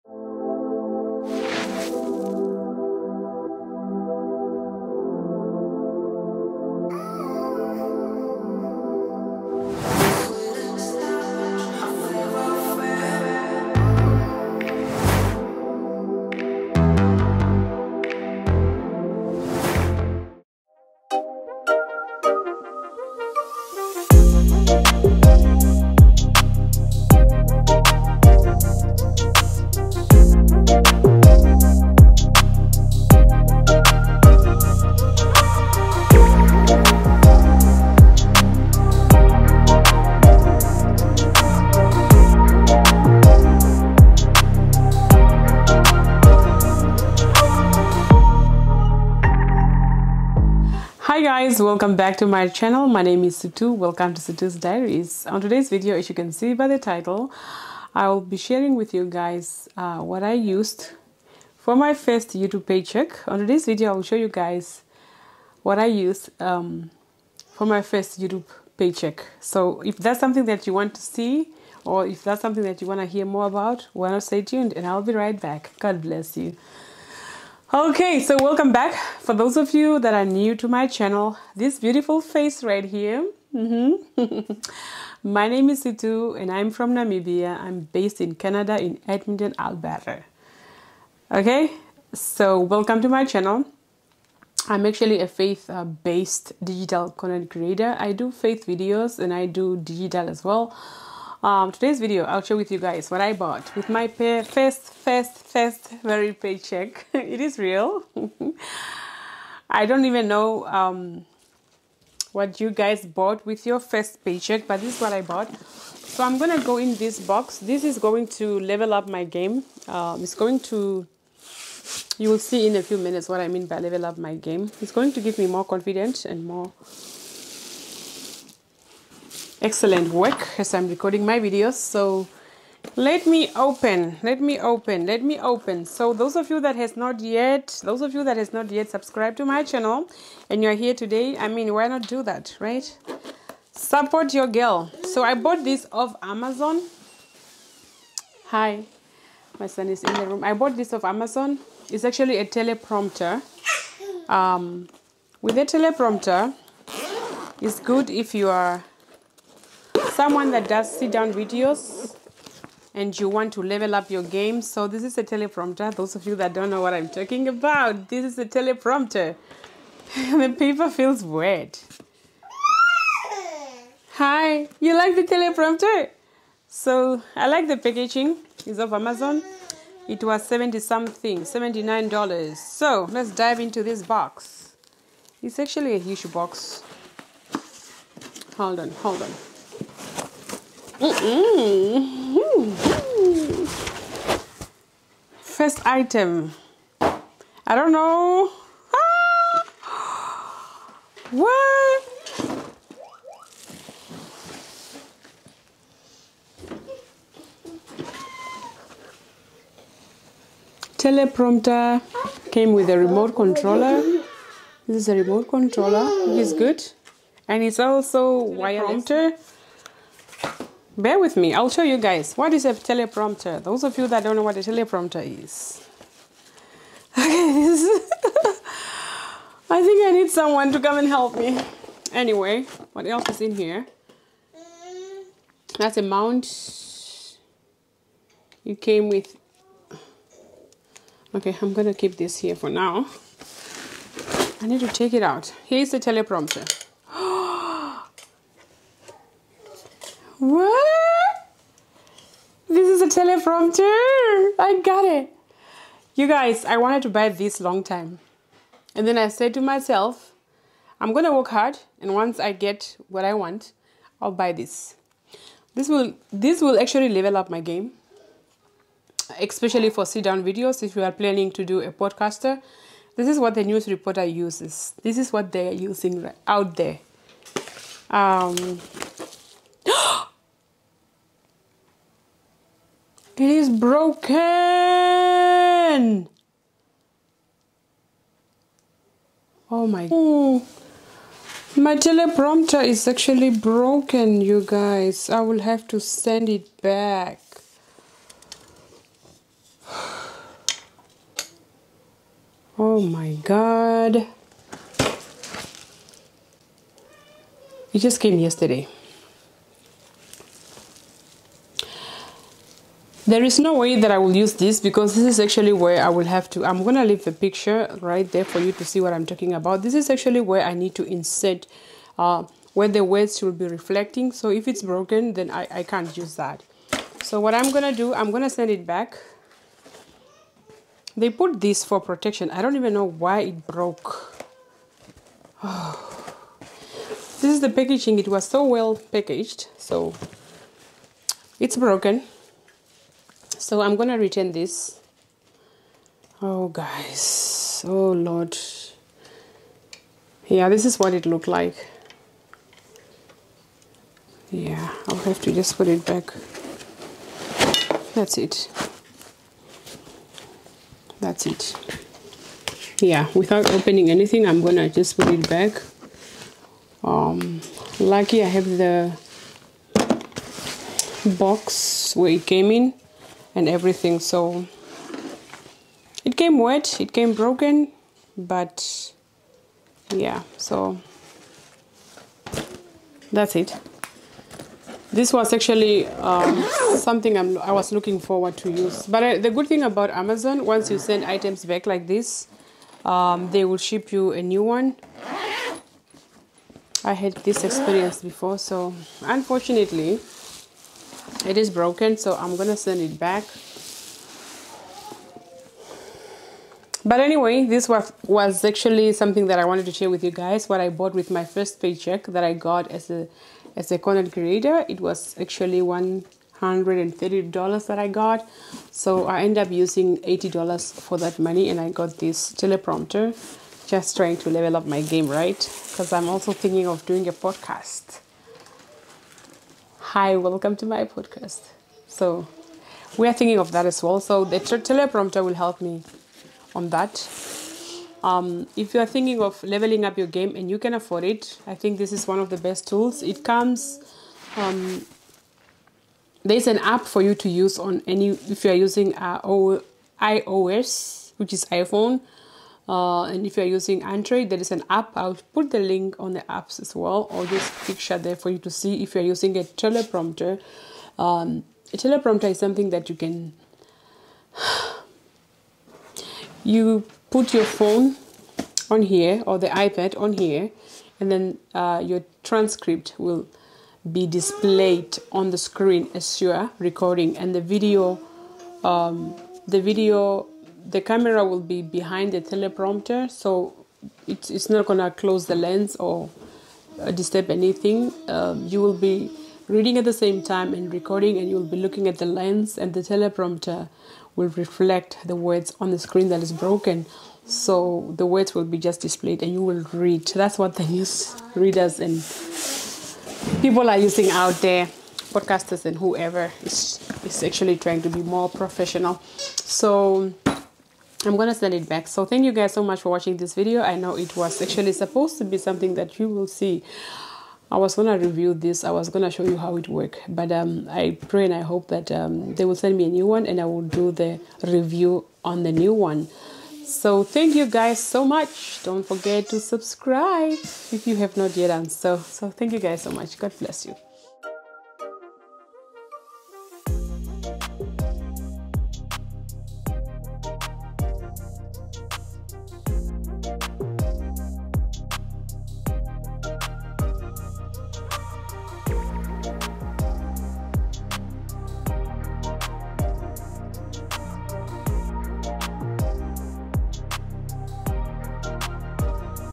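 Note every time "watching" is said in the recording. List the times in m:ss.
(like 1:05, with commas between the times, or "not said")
8:33.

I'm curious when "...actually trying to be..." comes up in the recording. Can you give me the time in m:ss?
8:27.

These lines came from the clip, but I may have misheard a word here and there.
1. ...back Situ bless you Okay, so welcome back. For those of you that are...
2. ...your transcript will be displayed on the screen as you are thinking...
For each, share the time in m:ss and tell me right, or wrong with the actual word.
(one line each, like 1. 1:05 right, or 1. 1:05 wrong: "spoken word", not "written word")
1. 1:15 wrong: "God", not "Situ"
2. 7:52 wrong: "recording", not "thinking".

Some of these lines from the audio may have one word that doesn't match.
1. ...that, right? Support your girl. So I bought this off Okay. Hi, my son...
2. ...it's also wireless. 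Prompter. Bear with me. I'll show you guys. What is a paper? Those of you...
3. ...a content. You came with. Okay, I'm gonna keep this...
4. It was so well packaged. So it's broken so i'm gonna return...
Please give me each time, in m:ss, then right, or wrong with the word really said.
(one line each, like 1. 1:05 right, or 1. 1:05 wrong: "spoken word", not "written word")
1. 2:22 wrong: "Amazon", not "Okay"
2. 3:37 wrong: "teleprompter", not "paper"
3. 3:55 wrong: "mount", not "content"
4. 5:38 right.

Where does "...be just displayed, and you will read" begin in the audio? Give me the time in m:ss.
8:18.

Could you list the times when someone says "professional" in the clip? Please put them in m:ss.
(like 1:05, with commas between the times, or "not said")
8:28.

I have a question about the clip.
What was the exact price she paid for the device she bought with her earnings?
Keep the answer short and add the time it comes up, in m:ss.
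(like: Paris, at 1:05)
$79, at 3:01.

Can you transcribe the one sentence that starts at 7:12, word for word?
So, we are thinking of that as well.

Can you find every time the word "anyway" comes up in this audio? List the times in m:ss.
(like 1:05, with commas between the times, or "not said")
3:52, 6:47.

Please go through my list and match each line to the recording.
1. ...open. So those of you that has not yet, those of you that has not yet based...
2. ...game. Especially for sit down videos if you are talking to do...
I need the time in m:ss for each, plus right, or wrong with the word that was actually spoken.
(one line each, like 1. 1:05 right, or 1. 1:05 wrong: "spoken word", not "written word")
1. 2:15 wrong: "subscribed", not "based"
2. 4:27 wrong: "planning", not "talking".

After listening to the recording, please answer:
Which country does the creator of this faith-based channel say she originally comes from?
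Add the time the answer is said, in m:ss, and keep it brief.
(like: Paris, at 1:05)
Namibia, at 1:26.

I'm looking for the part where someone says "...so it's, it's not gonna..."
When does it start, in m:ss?
8:03.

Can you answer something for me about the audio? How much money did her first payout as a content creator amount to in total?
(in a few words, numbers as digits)
$130.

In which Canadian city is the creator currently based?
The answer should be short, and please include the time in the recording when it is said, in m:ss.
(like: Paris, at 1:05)
Edmonton, at 1:29.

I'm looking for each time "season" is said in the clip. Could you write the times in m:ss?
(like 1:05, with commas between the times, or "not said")
not said.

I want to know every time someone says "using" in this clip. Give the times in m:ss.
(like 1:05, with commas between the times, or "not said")
4:35, 6:59, 7:28, 7:33, 7:39, 8:23.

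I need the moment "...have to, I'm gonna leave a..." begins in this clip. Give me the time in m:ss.
5:16.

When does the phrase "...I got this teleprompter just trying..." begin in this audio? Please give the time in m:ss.
7:01.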